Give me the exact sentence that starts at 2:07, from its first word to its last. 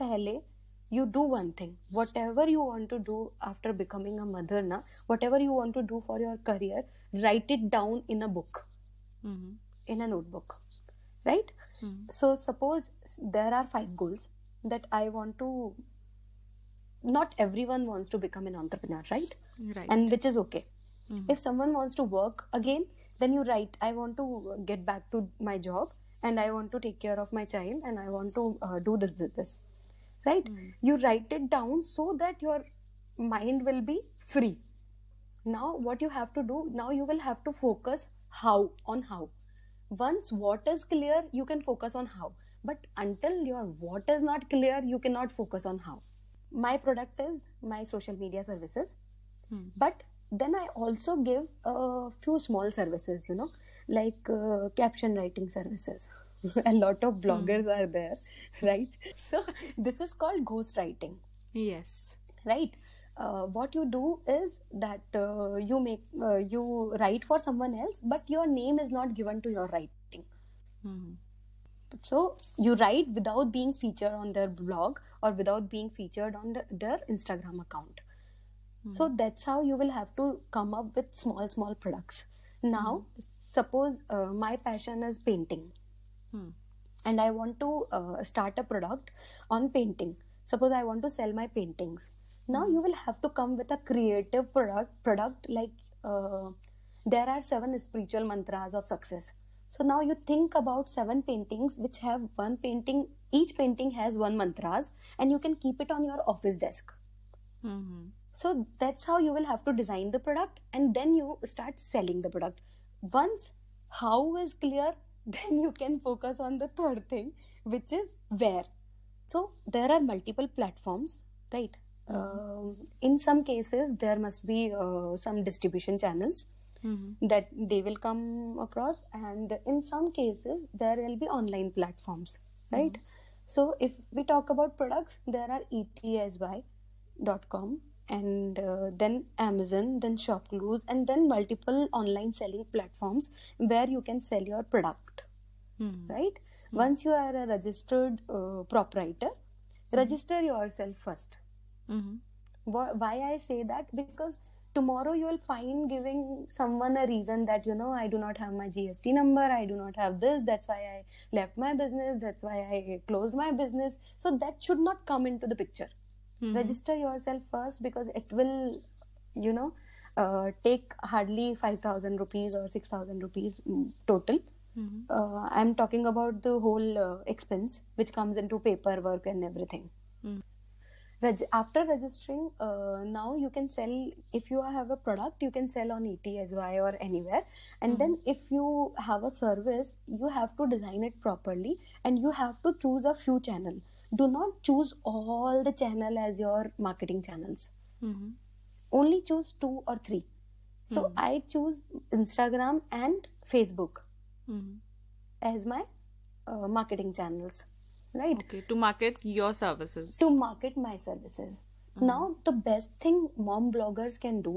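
that they will come across and in some cases there will be online platforms mm-hmm.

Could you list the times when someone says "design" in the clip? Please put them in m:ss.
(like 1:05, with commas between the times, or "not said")
1:49, 3:10.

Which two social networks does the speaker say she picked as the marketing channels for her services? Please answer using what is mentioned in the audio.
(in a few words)
Instagram and Facebook.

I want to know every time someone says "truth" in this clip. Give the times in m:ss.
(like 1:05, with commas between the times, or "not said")
not said.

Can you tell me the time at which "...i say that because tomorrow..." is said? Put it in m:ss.
2:33.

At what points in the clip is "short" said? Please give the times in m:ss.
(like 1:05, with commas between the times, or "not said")
not said.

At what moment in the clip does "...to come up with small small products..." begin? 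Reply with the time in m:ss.
1:20.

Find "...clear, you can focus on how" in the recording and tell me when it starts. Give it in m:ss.
0:40.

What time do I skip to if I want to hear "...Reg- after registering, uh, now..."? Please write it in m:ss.
3:01.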